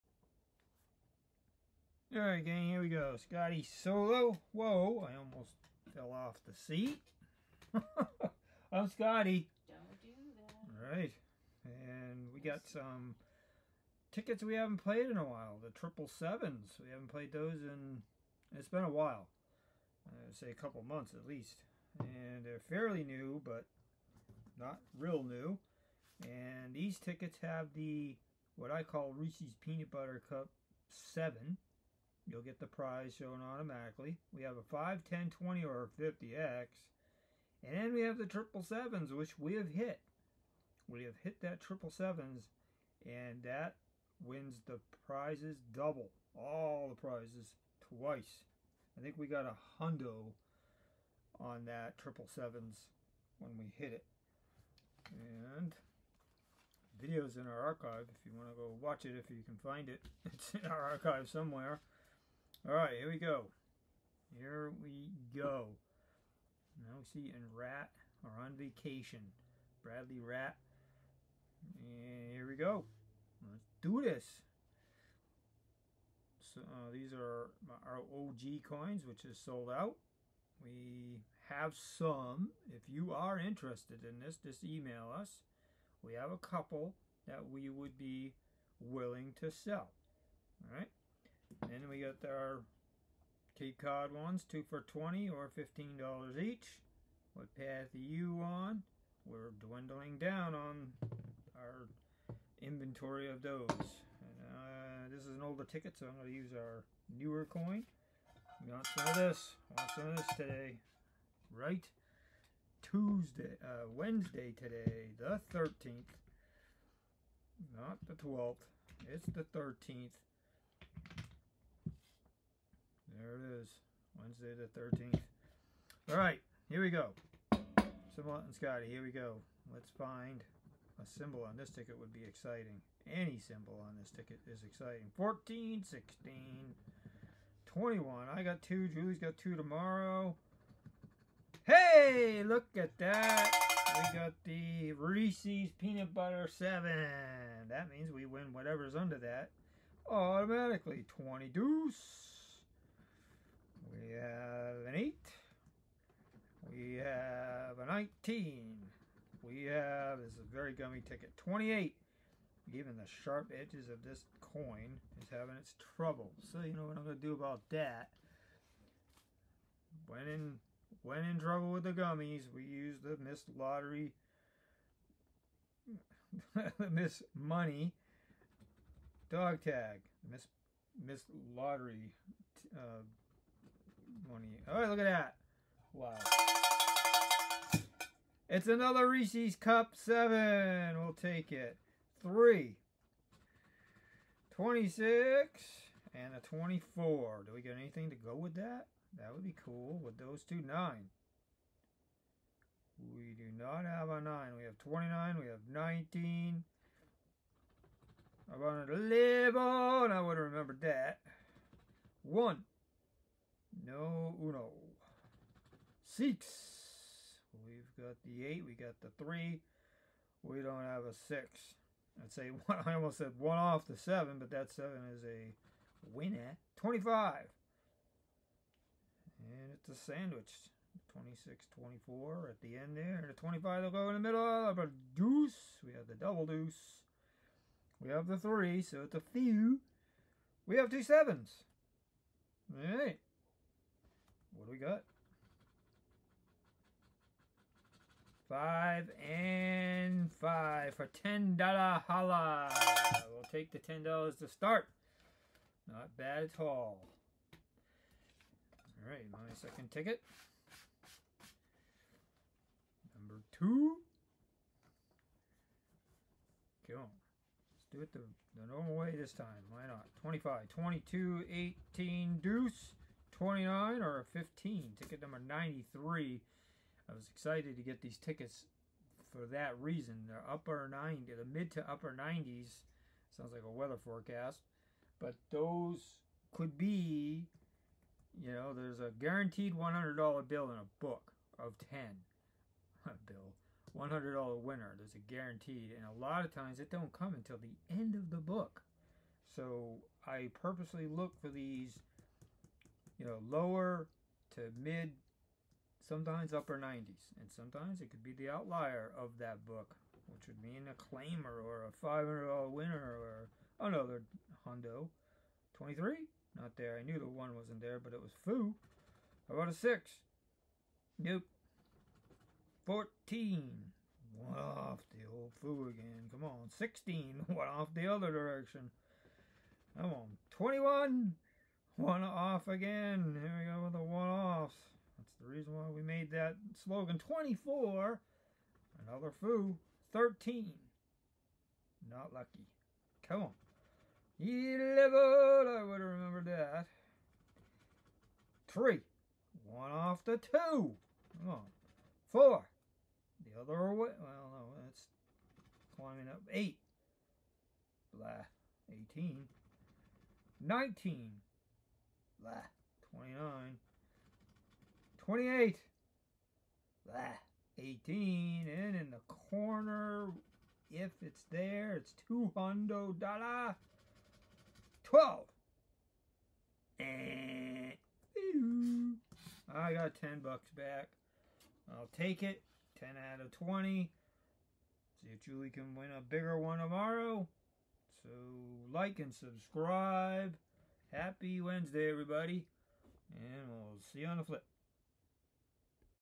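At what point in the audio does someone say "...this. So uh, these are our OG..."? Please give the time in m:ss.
1:14.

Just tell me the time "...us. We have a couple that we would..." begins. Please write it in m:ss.
1:25.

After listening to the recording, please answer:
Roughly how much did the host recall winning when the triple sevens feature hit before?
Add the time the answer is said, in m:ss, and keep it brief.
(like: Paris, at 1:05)
a hundo, at 0:49.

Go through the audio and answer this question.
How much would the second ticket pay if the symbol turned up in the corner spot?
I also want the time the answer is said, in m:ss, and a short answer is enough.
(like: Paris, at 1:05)
$200, at 6:12.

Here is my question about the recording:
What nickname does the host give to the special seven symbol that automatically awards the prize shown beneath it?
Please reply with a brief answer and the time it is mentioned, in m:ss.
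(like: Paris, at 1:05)
Reese's Peanut Butter Cup 7, at 0:29.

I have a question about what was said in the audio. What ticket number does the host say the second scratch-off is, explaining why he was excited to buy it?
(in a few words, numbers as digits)
93.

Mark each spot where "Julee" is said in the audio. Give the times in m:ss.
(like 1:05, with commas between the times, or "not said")
2:18, 6:25.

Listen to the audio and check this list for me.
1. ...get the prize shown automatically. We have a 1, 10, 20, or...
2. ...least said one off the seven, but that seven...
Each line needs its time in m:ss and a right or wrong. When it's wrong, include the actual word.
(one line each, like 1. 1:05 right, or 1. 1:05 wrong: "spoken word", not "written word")
1. 0:32 wrong: "5", not "1"
2. 3:42 wrong: "almost", not "least".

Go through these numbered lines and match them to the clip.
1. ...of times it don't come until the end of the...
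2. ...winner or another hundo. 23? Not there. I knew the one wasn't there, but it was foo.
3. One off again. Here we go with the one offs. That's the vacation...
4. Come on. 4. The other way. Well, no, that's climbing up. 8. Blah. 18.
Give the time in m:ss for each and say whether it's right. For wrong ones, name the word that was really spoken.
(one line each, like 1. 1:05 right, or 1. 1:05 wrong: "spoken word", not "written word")
1. 4:56 right
2. 5:12 right
3. 5:31 wrong: "reason", not "vacation"
4. 5:50 right.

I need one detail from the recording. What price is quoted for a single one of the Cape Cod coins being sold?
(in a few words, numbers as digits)
$15.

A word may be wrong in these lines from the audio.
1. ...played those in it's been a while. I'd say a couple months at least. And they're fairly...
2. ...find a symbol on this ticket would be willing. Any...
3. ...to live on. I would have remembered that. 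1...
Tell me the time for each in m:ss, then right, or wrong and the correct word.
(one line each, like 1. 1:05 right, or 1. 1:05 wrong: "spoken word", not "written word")
1. 0:17 right
2. 2:09 wrong: "exciting", not "willing"
3. 3:28 right.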